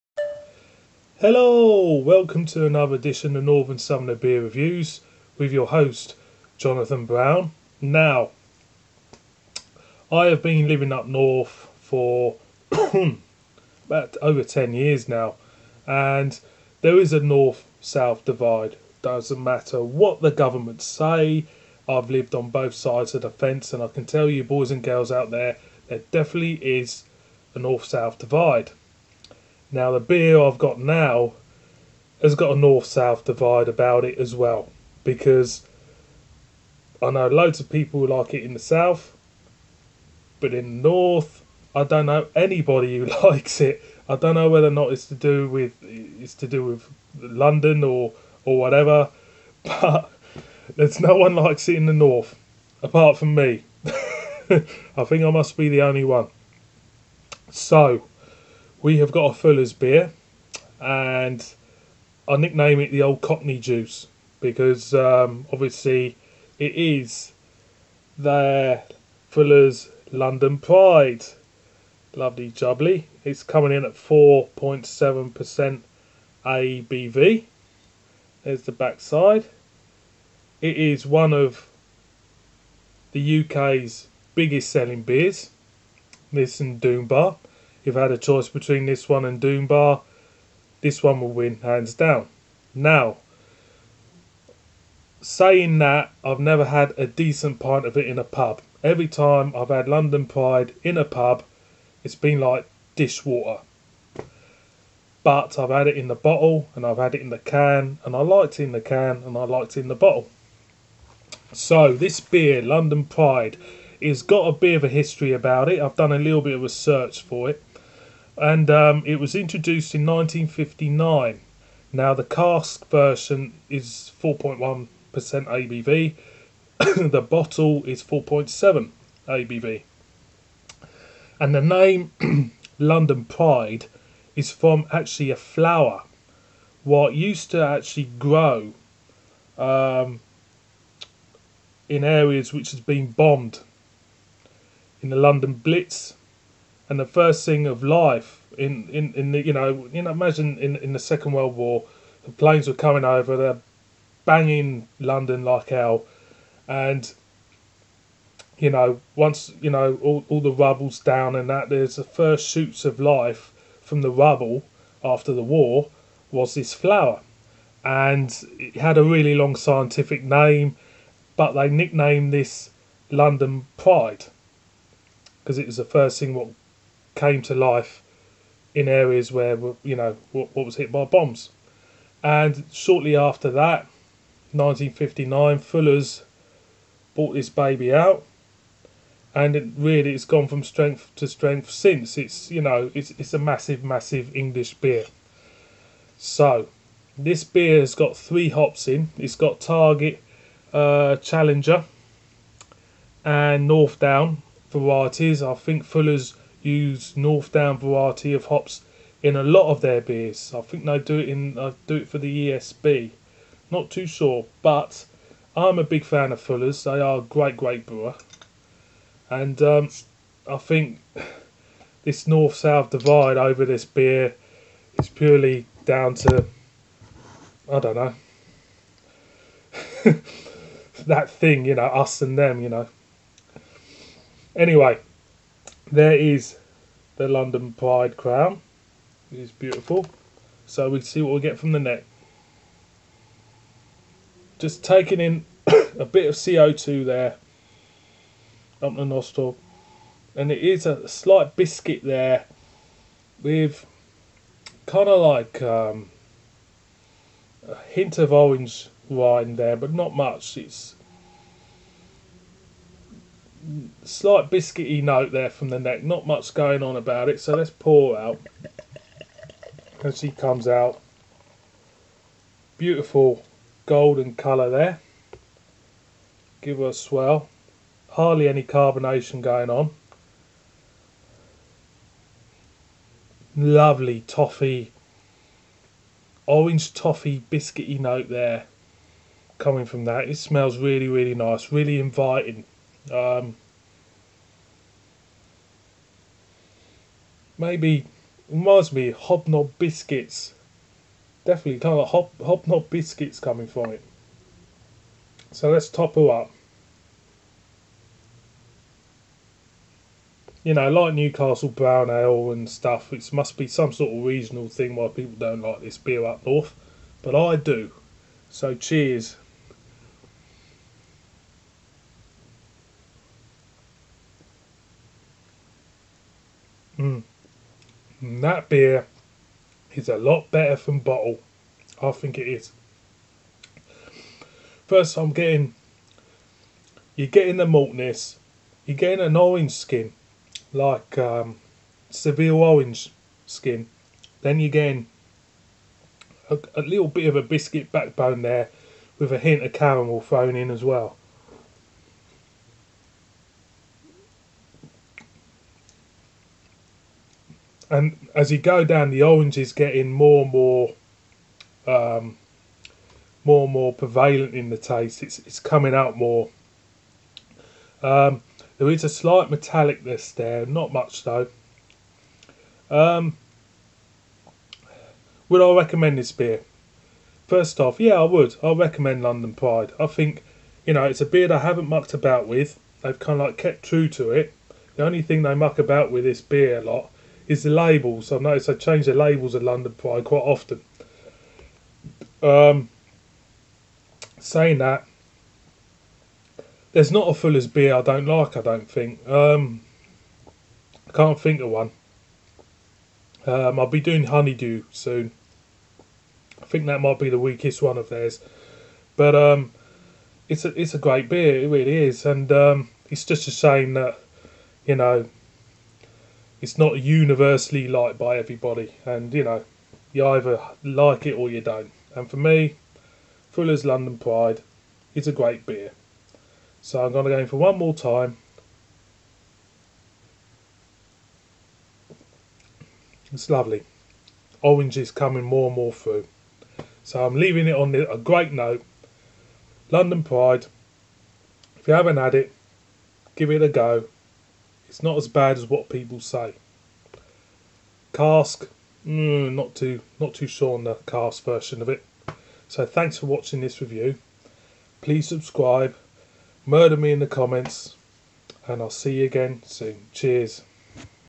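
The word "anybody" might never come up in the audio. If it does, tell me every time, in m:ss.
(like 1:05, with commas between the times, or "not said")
0:42.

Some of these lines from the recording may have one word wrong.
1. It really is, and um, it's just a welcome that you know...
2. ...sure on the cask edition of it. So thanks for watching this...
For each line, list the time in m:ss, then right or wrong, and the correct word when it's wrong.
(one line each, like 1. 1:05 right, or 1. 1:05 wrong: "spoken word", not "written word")
1. 6:51 wrong: "shame", not "welcome"
2. 7:30 wrong: "version", not "edition".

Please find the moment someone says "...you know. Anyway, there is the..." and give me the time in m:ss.
3:52.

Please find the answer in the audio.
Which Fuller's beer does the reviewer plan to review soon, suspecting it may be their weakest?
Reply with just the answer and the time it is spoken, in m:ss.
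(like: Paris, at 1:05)
Honeydew, at 6:44.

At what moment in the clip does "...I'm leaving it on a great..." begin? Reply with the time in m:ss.
7:17.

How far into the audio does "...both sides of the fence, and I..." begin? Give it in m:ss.
0:22.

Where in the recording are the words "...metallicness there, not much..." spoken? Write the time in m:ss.
6:09.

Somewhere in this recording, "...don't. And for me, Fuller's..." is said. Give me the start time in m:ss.
7:01.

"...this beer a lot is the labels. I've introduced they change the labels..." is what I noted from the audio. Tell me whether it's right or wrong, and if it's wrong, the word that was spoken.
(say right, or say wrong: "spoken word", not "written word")
wrong: "noticed", not "introduced".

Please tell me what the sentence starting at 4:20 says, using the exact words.
It's slight biscuity note there from the neck.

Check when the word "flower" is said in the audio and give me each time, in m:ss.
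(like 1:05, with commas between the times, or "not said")
2:15, 2:46.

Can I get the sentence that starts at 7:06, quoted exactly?
So I'm going to go in for one more time.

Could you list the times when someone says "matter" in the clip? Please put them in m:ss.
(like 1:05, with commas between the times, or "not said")
0:19.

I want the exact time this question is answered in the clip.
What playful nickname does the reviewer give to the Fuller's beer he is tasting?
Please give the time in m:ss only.
1:02.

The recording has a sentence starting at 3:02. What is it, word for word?
And shortly after that, 1959, Fuller's bought this baby out, and it really it's gone from strength to strength since.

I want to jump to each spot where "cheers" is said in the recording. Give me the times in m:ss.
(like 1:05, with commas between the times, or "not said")
5:18, 7:40.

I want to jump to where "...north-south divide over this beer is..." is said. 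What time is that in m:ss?
3:42.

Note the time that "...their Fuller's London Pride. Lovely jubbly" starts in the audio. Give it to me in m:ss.
1:08.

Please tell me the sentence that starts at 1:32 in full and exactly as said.
Now, saying that, I've never had a decent pint of it in a pub.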